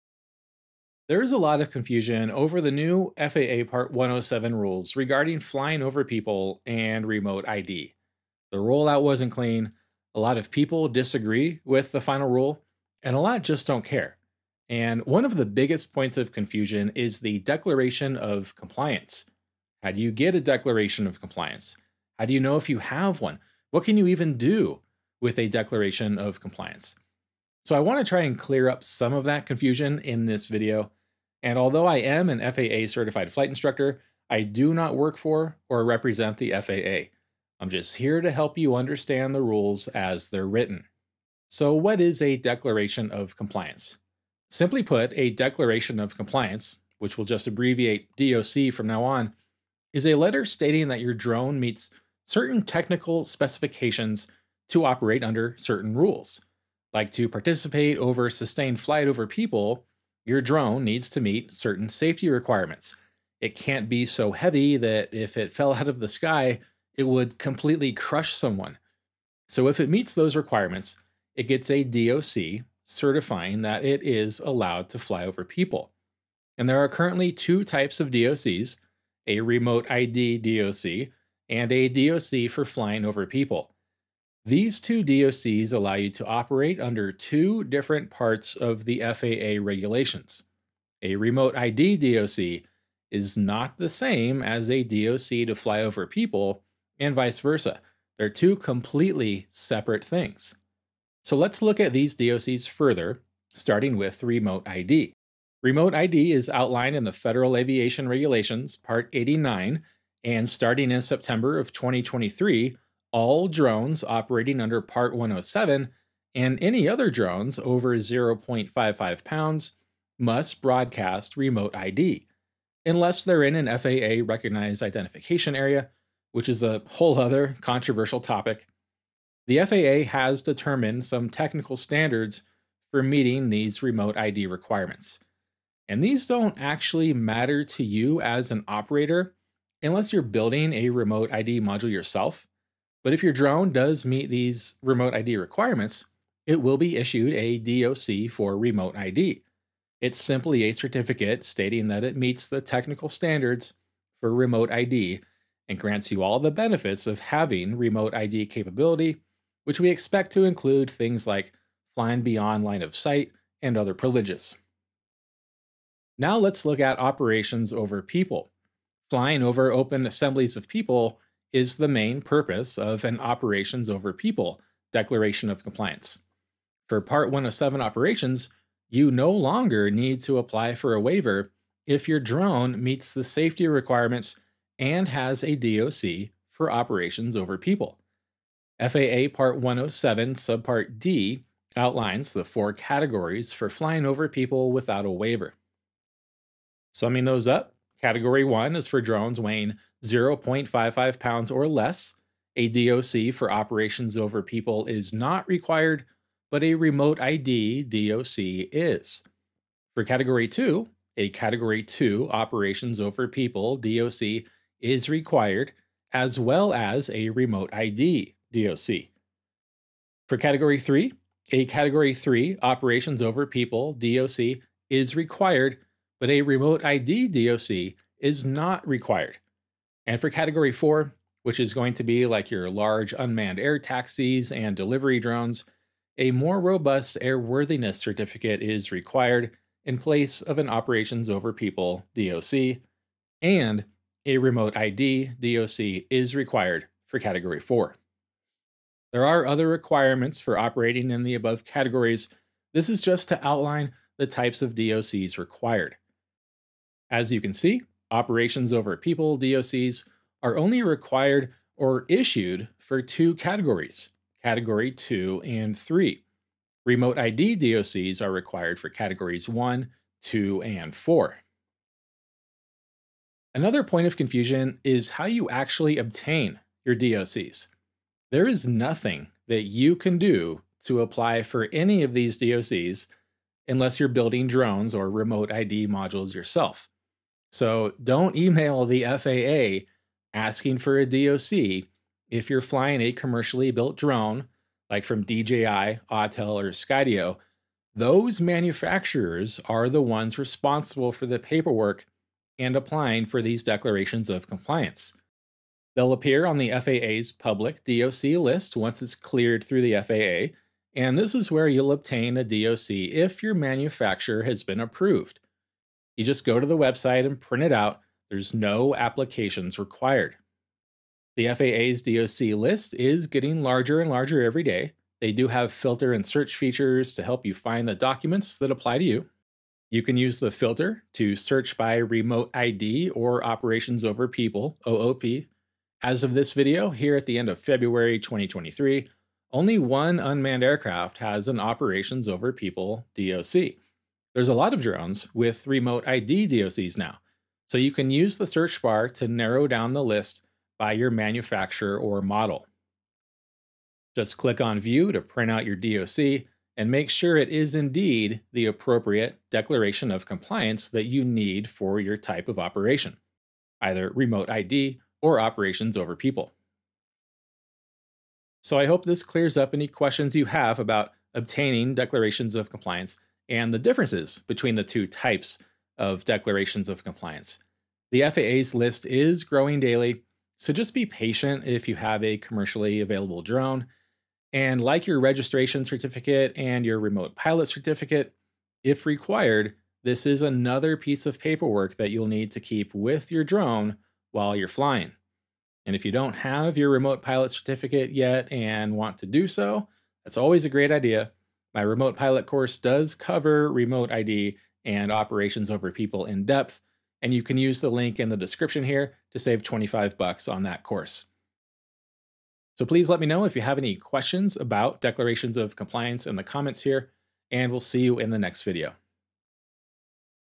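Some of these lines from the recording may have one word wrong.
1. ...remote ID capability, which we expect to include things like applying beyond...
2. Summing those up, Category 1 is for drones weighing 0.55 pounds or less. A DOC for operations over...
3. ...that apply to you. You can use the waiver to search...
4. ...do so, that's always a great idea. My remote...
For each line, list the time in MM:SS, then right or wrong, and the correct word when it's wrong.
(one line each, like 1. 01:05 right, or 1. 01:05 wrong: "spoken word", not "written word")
1. 02:37 wrong: "flying", not "applying"
2. 03:16 right
3. 05:28 wrong: "filter", not "waiver"
4. 06:39 right.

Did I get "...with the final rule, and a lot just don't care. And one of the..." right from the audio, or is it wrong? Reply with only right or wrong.
right.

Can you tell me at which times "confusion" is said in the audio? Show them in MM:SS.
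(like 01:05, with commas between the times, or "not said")
00:01, 00:16, 00:29, 04:34.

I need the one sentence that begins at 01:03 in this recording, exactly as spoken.
It can't be so heavy that if it fell out of the sky, it would completely crush someone.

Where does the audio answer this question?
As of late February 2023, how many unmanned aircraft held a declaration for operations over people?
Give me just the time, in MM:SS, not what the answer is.
05:39.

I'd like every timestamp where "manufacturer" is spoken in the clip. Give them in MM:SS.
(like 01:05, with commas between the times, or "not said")
04:58, 05:13, 05:51.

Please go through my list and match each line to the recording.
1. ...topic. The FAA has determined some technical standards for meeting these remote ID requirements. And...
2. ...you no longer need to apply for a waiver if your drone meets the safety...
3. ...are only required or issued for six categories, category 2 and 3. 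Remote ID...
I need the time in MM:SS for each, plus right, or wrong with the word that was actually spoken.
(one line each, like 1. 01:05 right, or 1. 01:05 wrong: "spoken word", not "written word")
1. 02:08 right
2. 02:58 right
3. 04:20 wrong: "two", not "six".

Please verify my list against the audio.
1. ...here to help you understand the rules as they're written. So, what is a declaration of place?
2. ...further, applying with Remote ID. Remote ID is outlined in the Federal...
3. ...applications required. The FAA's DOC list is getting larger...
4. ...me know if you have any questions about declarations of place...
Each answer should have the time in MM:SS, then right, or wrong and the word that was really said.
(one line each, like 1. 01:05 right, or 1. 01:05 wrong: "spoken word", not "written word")
1. 00:37 wrong: "compliance", not "place"
2. 01:42 wrong: "starting", not "applying"
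3. 05:18 right
4. 06:53 wrong: "compliance", not "place".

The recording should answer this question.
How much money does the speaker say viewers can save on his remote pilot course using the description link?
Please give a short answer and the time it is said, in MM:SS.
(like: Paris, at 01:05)
$25, at 06:49.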